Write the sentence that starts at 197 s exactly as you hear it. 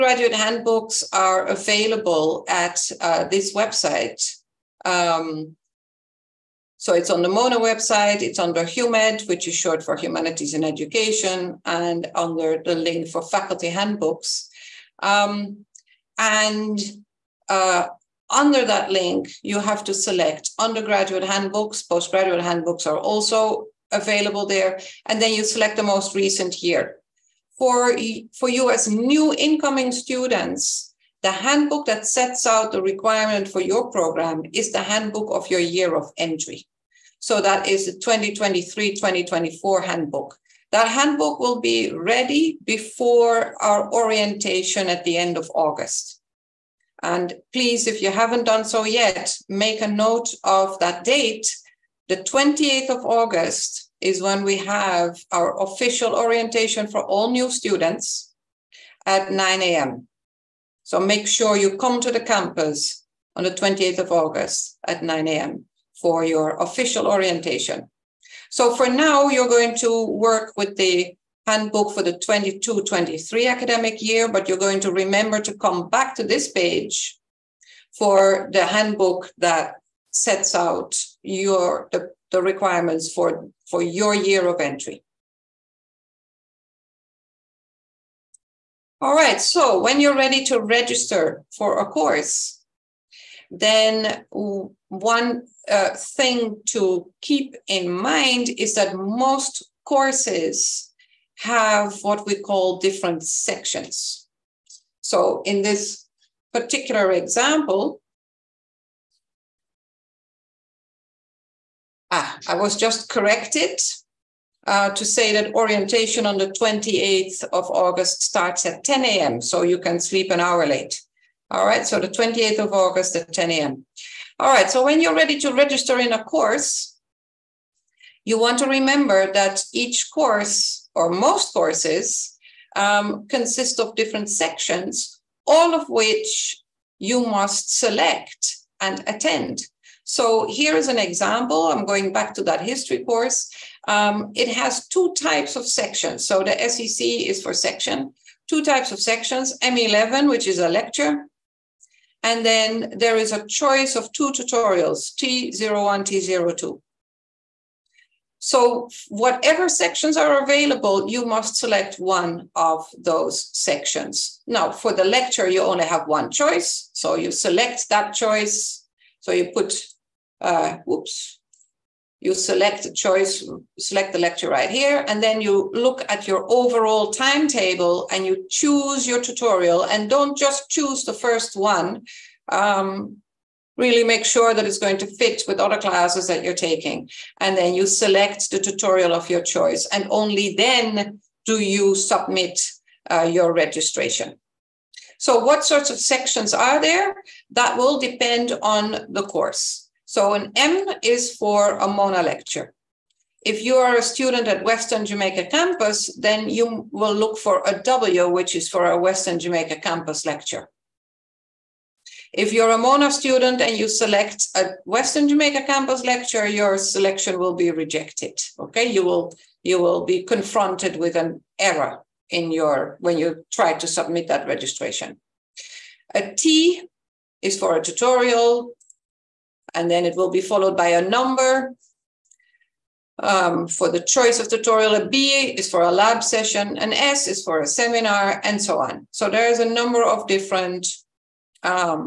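That will depend on the course.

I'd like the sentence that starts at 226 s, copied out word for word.
A T is for a tutorial, and then it will be followed by a number um, for the choice of tutorial.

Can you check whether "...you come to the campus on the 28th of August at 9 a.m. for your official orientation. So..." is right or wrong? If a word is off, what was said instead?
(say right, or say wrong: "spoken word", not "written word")
right.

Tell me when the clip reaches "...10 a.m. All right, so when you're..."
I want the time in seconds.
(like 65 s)
123 s.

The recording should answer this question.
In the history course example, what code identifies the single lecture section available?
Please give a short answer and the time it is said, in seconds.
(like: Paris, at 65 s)
M11, at 149 s.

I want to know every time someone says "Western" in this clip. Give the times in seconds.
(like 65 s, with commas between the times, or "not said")
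204 s, 208 s, 214 s.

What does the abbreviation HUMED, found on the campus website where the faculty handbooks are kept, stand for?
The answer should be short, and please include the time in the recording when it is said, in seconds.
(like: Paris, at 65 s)
Humanities in Education, at 9 s.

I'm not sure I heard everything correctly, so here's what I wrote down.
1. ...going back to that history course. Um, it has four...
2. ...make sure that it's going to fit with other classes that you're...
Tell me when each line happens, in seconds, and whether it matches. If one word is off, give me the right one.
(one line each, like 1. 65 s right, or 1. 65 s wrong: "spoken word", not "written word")
1. 141 s wrong: "two", not "four"
2. 184 s right.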